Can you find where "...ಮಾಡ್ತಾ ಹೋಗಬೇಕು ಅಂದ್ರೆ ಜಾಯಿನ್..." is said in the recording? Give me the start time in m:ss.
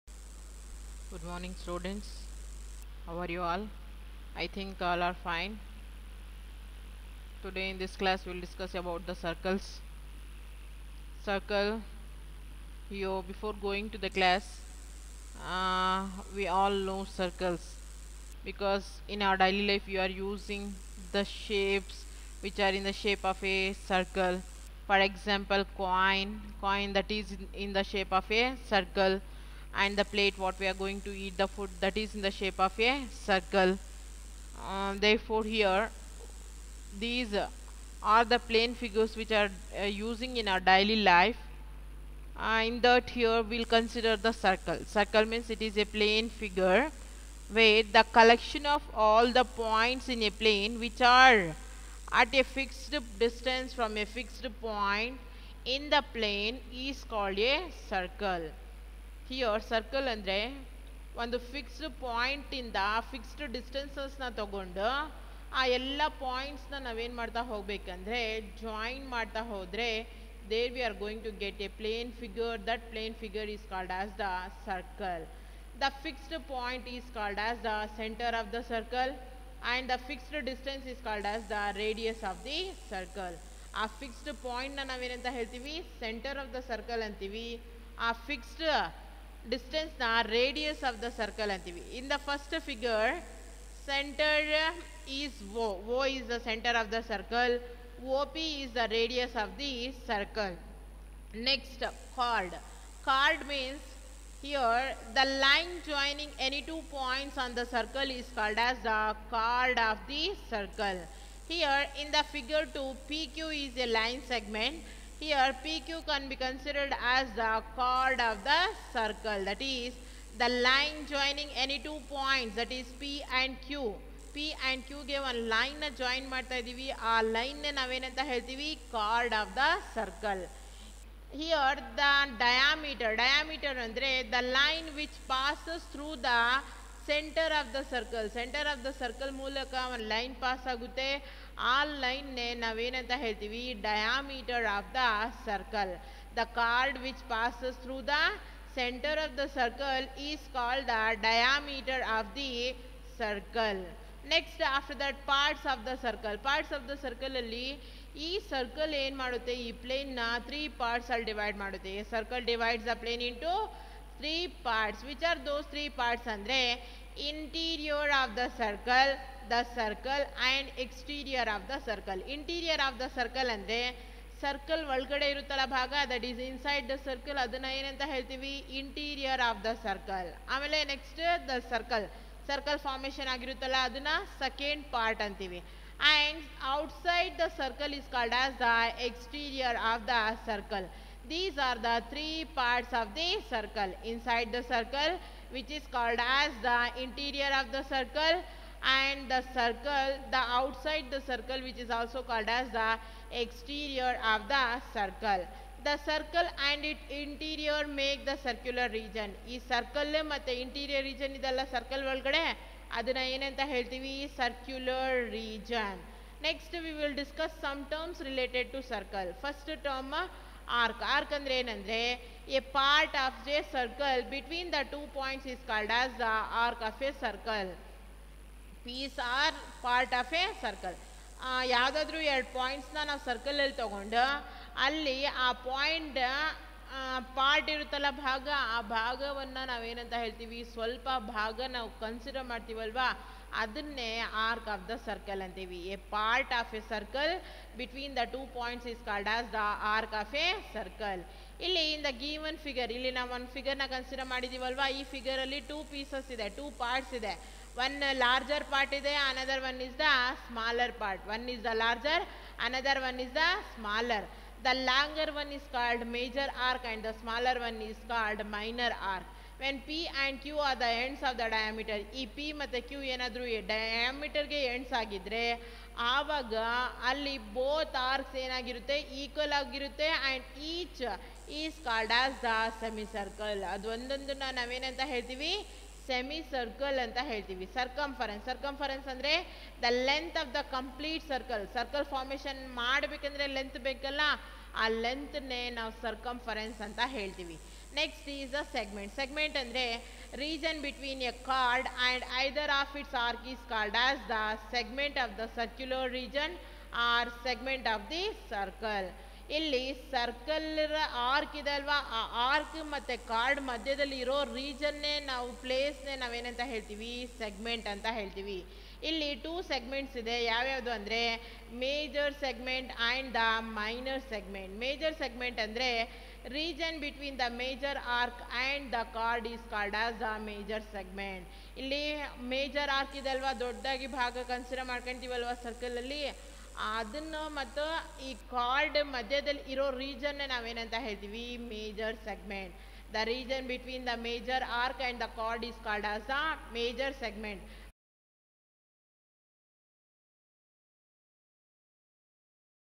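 1:07.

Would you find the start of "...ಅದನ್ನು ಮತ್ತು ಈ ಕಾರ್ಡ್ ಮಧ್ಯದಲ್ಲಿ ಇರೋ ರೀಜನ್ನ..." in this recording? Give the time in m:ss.
5:36.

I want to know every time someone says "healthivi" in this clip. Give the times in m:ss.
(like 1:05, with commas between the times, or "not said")
2:08.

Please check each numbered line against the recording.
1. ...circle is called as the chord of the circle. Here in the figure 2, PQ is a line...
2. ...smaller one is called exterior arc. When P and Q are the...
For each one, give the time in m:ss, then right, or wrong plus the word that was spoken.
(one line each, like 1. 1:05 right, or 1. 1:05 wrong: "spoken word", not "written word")
1. 1:47 right
2. 4:27 wrong: "minor", not "exterior".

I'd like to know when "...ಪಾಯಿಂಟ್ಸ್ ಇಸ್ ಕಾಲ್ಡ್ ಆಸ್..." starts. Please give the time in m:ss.
4:08.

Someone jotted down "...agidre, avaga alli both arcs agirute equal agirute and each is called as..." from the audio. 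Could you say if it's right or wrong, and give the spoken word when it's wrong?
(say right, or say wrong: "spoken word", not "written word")
wrong: "yenagirute", not "agirute".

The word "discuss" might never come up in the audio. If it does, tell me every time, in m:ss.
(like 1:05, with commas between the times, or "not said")
0:08, 3:37.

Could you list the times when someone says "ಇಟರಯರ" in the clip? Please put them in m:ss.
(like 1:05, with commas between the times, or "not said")
2:58, 3:30.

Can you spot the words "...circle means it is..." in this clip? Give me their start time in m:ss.
0:44.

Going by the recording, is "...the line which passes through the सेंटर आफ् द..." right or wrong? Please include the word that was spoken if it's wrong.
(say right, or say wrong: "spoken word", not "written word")
right.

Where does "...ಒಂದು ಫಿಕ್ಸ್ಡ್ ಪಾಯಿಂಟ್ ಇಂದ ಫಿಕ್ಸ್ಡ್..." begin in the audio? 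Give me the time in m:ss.
1:01.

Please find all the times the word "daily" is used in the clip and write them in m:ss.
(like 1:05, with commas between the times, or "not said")
0:19, 0:40.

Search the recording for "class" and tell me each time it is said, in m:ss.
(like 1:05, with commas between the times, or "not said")
0:08, 0:14.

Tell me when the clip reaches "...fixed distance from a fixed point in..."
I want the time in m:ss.
0:52.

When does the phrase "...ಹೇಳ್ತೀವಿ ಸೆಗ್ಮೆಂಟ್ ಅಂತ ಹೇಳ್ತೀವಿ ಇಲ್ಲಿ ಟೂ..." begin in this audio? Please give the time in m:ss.
5:16.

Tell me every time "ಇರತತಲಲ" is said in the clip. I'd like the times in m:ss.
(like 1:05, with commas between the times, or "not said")
2:55, 3:57.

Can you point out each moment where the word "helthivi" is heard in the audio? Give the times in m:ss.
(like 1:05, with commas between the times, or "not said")
4:45.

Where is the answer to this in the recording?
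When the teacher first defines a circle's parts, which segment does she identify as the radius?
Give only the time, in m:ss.
1:38.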